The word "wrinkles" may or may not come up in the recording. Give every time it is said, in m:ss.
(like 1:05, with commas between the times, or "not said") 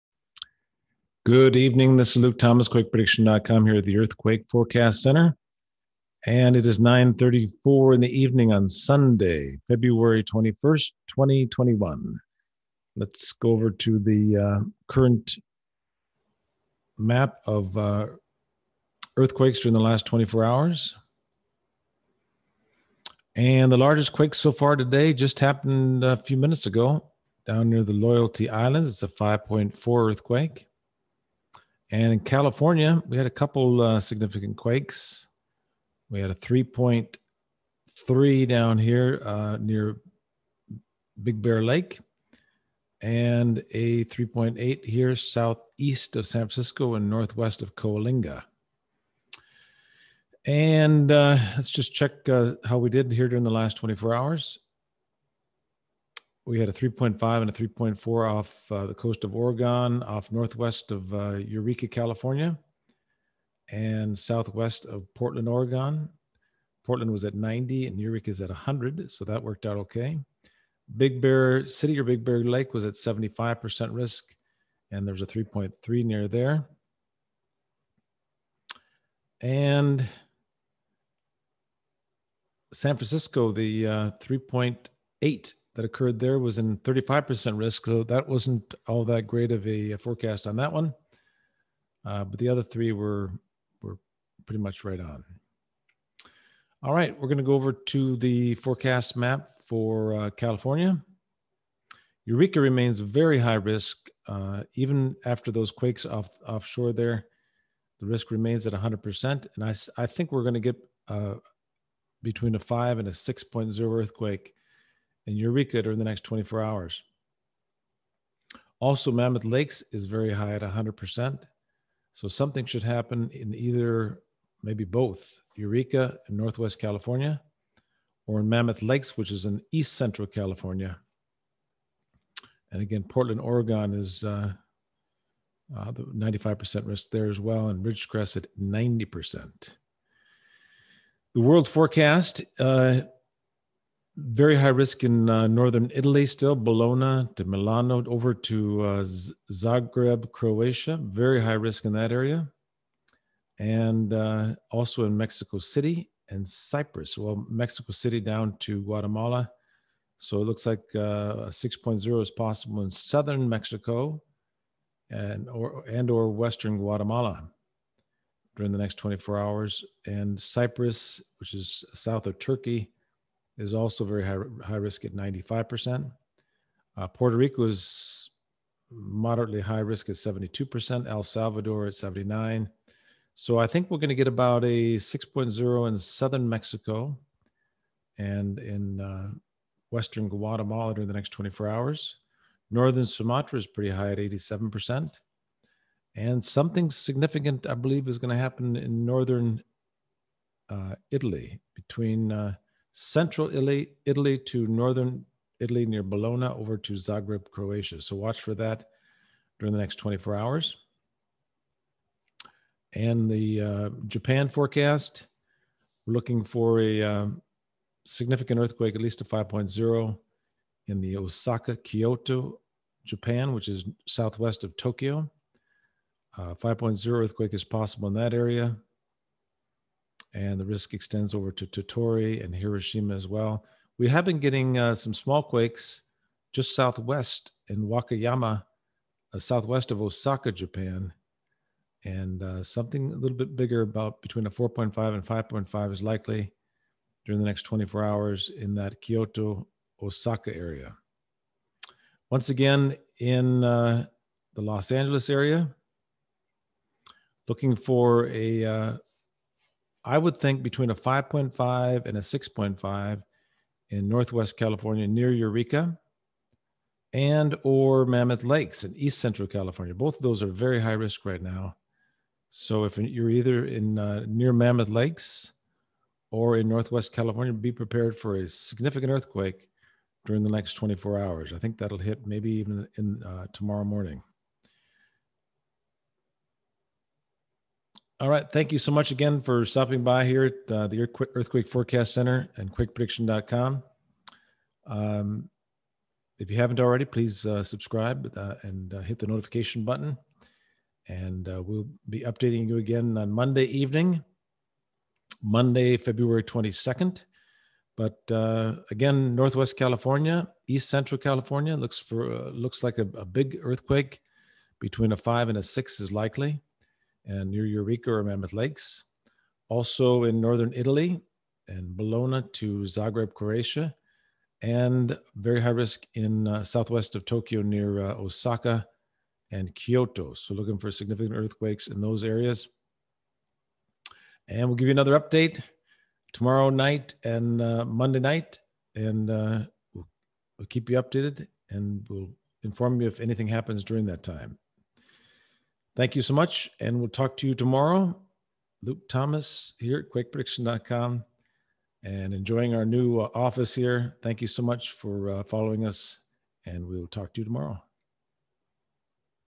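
not said.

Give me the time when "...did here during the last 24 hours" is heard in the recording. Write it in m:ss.
0:52.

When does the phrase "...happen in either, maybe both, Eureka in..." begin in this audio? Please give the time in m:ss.
2:02.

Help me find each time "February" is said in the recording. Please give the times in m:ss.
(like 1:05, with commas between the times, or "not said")
0:09, 5:05.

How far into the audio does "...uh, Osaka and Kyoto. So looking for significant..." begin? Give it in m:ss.
5:28.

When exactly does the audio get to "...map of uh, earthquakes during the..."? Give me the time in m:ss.
0:16.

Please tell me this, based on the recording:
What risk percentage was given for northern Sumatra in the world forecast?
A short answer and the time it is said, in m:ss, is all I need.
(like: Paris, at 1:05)
87%, at 3:14.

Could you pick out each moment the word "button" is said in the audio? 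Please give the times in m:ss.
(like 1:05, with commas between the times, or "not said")
4:59.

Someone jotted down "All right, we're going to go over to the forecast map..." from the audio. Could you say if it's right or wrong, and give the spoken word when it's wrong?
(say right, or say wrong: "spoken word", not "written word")
right.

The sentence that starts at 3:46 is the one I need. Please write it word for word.
Uh, 5.0 earthquake is possible in that area and the risk extends over to Tottori and Hiroshima as well.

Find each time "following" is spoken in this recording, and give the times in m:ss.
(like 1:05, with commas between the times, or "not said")
5:55.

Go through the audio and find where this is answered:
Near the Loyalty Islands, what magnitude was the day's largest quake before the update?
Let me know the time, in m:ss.
0:29.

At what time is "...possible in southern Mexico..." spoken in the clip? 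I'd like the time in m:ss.
2:42.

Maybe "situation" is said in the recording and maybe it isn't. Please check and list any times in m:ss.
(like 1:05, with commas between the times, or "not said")
not said.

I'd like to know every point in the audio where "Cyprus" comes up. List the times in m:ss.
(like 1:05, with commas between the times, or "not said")
2:36, 2:50.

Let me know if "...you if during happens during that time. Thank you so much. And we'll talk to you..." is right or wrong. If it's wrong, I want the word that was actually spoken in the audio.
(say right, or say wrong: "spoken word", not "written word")
wrong: "anything", not "during".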